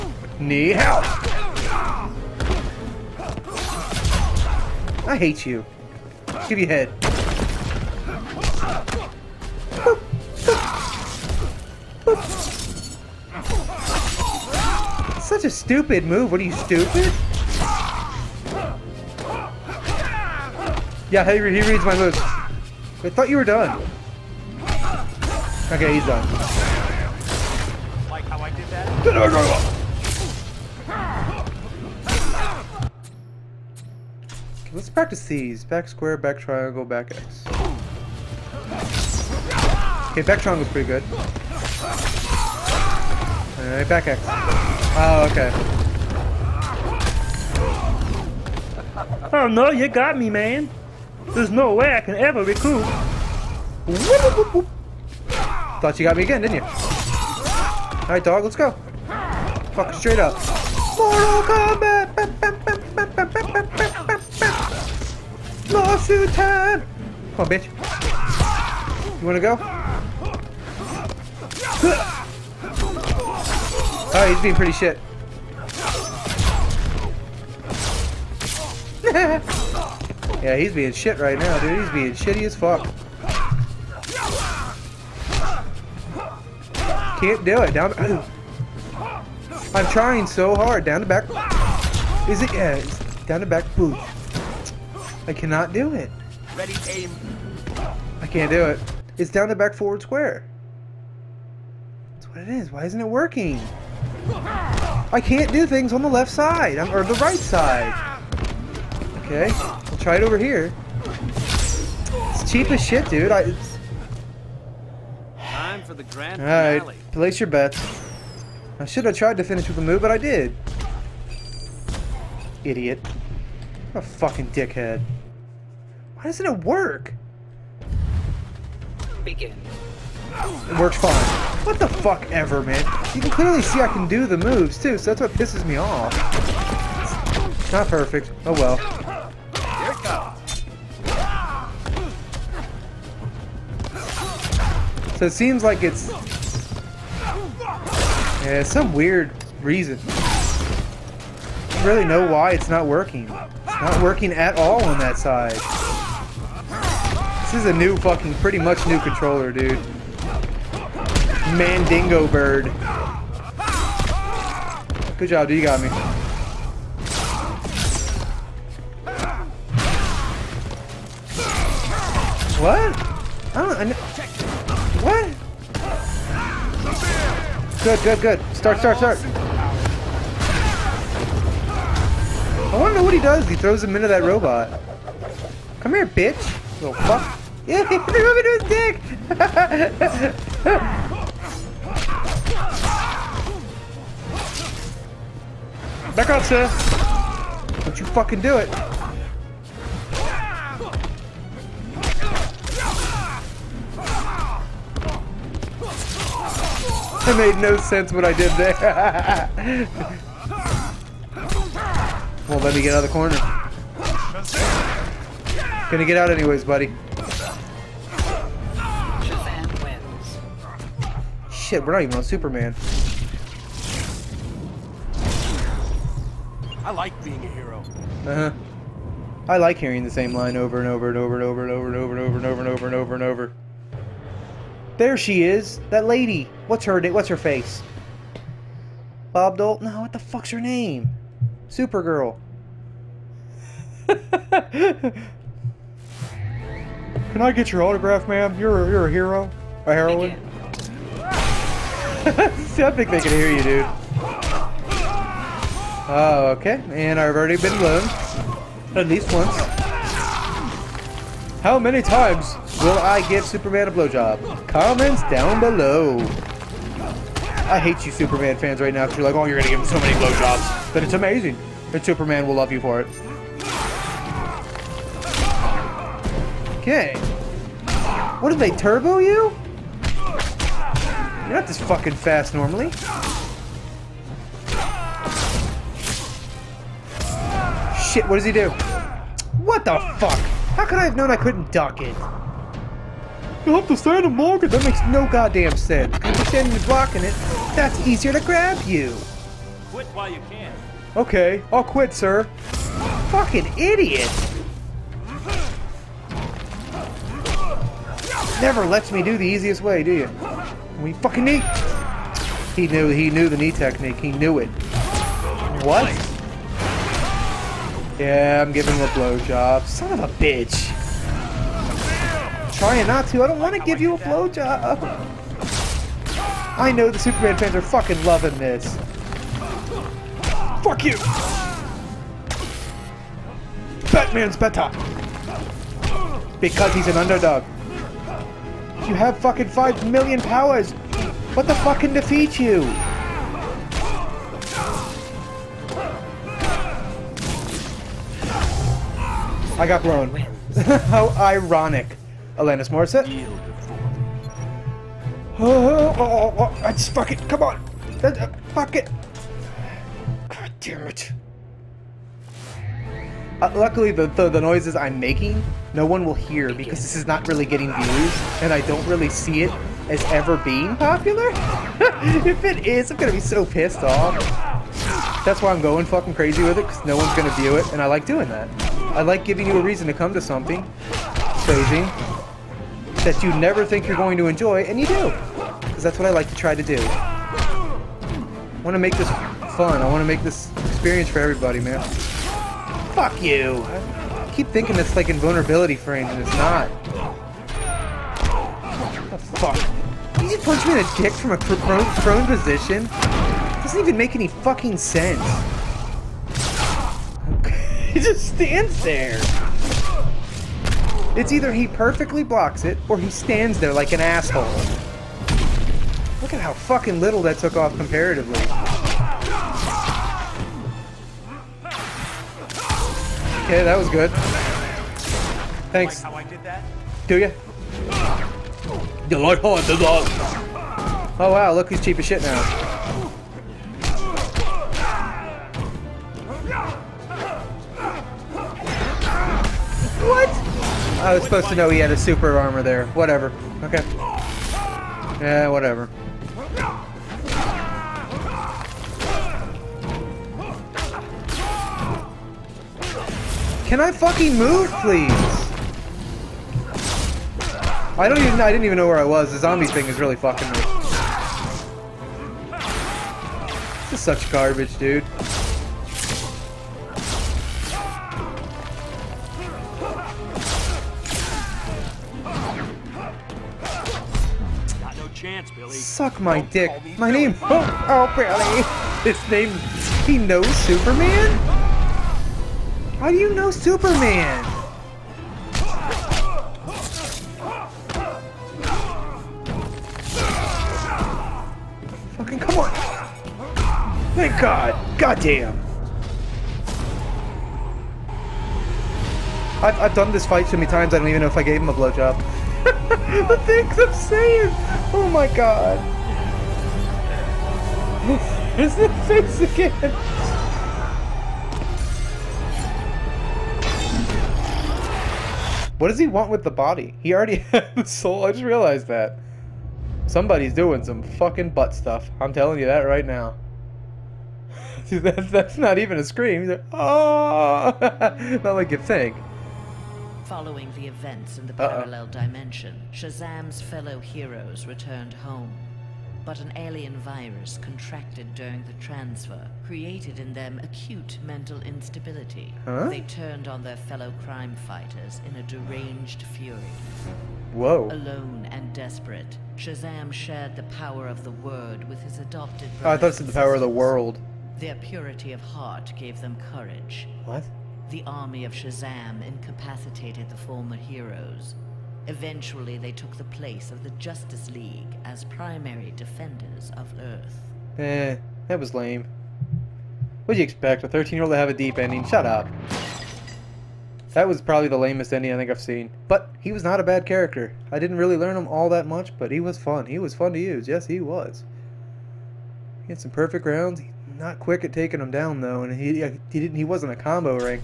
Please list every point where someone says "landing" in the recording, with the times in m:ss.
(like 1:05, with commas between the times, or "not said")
not said.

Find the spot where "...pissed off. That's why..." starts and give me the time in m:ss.
6:13.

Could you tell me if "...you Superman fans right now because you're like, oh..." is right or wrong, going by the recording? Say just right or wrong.
right.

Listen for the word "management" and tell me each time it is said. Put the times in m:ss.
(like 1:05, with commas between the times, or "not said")
not said.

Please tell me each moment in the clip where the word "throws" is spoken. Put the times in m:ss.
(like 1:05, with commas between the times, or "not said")
3:03.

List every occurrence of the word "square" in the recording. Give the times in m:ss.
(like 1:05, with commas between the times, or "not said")
0:35, 1:40.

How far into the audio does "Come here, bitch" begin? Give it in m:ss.
3:05.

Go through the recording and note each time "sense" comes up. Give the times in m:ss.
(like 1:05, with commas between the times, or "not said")
3:27, 4:55, 6:44.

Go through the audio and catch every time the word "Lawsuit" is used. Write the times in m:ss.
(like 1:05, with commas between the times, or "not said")
1:05.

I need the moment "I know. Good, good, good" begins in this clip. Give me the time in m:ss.
2:53.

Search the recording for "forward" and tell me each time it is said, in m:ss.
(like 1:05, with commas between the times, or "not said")
1:39.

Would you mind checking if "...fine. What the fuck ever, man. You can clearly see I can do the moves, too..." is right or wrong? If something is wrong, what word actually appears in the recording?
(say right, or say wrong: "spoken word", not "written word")
right.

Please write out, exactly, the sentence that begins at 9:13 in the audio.
Oh, I thought it said the power of the world.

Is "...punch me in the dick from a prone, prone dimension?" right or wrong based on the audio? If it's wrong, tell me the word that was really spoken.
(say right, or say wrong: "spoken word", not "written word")
wrong: "position", not "dimension".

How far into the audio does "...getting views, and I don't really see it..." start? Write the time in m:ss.
6:07.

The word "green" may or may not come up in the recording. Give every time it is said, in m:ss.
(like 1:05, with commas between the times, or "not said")
not said.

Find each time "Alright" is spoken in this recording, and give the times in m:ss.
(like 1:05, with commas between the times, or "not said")
0:43, 0:56.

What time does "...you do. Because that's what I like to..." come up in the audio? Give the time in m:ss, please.
6:25.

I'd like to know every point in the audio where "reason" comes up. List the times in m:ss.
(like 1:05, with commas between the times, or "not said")
2:29, 6:19.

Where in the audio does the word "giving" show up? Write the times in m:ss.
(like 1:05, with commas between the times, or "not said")
5:18, 6:19.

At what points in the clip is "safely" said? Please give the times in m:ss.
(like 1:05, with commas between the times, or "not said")
not said.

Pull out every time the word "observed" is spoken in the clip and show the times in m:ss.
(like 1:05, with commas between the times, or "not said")
not said.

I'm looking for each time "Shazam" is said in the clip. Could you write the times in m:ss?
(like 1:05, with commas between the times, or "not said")
8:53, 9:09, 9:18.